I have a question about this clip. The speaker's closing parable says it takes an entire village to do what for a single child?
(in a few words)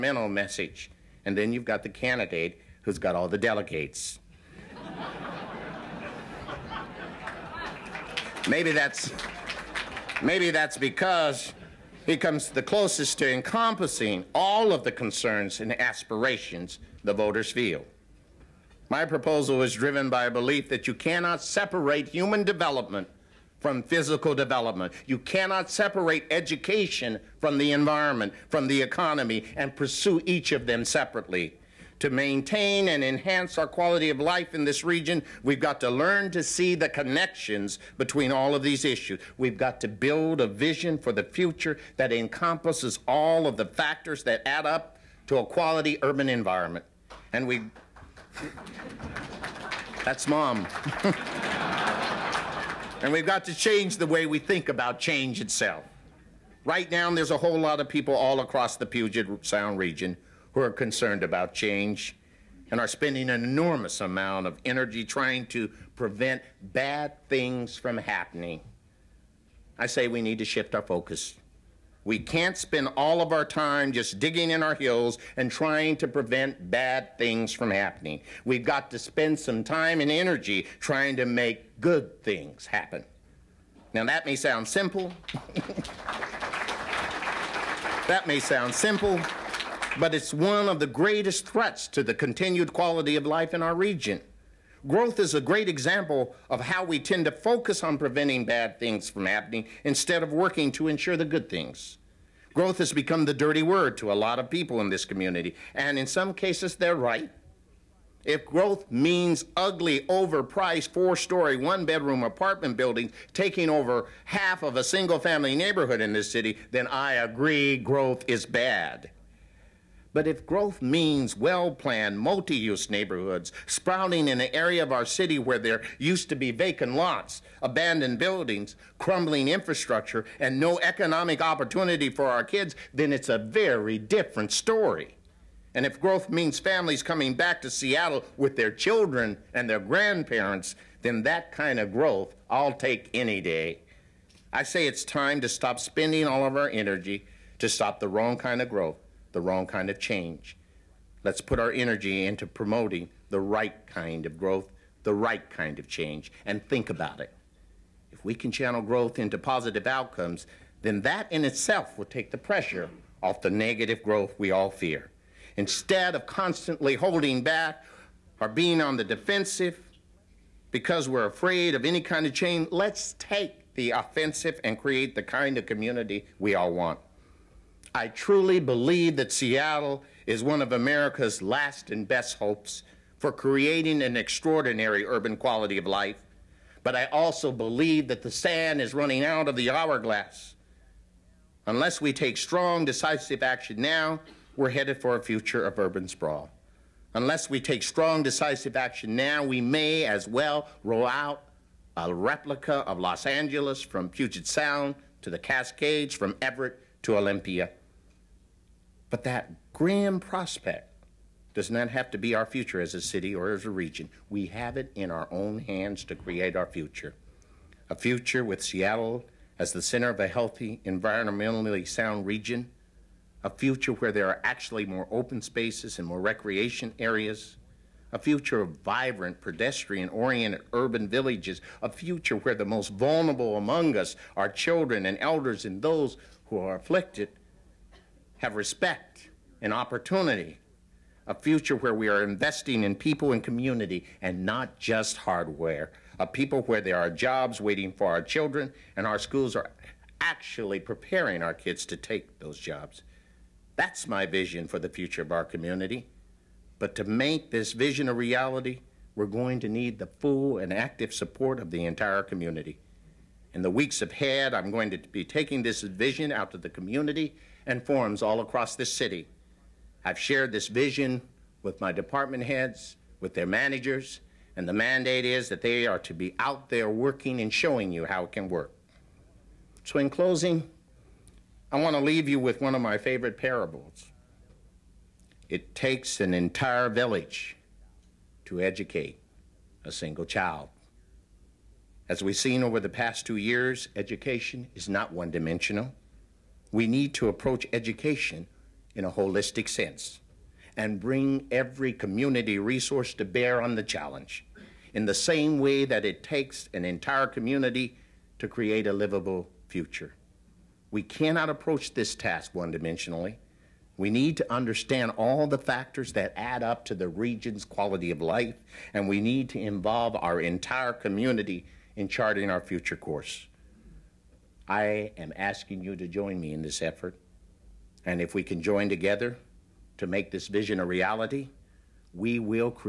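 educate.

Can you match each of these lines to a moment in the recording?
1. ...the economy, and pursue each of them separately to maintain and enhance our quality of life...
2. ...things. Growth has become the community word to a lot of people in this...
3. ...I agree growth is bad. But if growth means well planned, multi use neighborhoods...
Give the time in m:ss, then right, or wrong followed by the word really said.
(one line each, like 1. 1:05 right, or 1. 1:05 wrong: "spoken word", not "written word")
1. 0:28 right
2. 1:41 wrong: "dirty", not "community"
3. 1:56 right.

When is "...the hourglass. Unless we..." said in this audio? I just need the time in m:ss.
3:09.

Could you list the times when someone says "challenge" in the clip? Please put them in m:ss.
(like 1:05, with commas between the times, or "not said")
5:03.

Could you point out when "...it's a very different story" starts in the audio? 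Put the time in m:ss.
2:13.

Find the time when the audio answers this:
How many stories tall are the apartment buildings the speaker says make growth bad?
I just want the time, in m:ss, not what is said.
1:50.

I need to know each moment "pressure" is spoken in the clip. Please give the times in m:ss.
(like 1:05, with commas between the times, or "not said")
2:42.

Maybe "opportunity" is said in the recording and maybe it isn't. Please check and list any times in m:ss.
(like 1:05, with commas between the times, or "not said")
2:11, 3:59.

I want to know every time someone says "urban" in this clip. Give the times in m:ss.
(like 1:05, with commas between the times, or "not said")
0:46, 3:05, 3:15, 3:50.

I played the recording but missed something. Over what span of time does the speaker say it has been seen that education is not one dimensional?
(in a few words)
2 years.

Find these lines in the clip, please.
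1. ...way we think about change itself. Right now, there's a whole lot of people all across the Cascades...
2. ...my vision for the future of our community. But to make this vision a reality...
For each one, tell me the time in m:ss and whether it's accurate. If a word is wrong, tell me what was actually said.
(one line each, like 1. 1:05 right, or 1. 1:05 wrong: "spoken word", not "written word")
1. 0:54 wrong: "Puget", not "Cascades"
2. 4:14 right.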